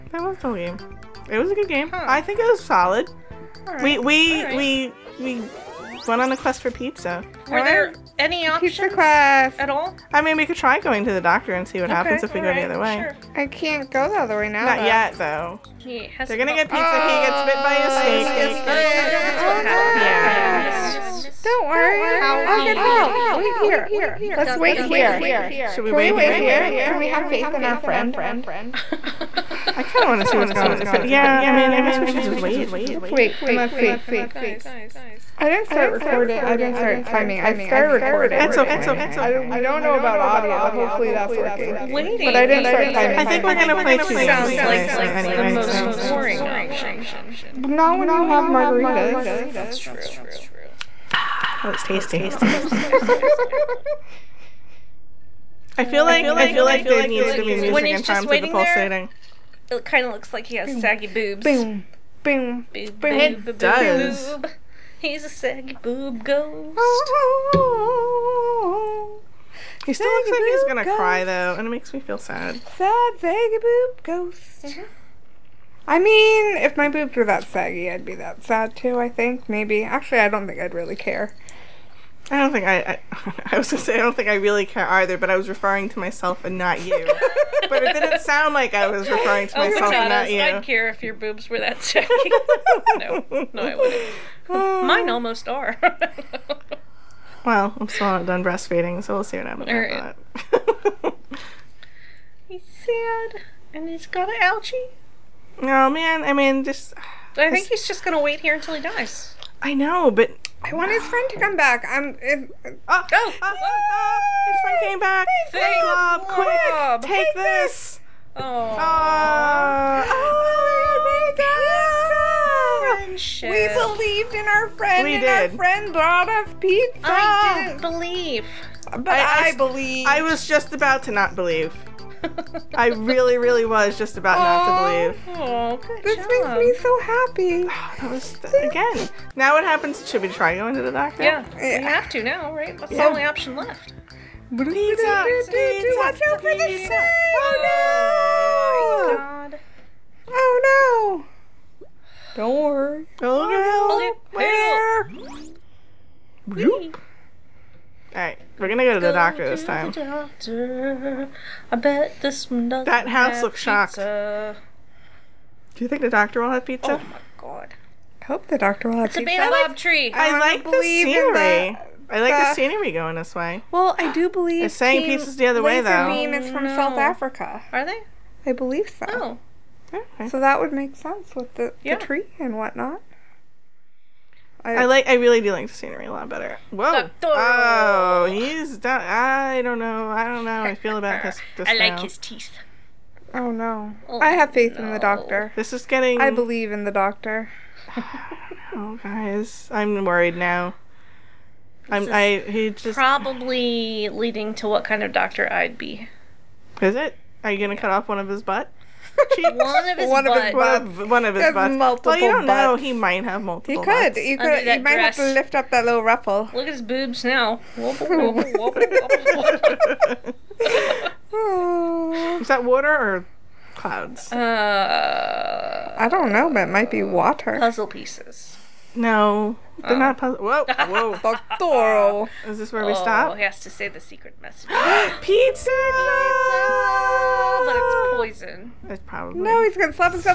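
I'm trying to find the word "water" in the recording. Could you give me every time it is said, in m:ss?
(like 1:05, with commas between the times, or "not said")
3:42, 3:47.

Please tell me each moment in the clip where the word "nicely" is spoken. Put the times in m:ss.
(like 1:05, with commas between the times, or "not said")
not said.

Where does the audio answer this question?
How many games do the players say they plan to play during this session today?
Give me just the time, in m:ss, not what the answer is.
0:43.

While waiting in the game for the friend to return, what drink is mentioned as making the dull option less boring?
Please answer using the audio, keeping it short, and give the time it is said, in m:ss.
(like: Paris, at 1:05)
margaritas, at 0:48.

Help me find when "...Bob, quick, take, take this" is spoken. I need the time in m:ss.
1:55.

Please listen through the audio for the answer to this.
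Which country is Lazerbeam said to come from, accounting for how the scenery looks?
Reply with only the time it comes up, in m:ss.
2:56.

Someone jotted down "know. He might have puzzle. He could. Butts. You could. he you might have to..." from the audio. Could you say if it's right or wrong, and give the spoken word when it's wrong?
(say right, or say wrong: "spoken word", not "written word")
wrong: "multiple", not "puzzle".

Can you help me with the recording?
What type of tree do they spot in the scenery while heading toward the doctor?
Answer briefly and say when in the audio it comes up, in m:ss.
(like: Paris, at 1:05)
baobab tree, at 2:49.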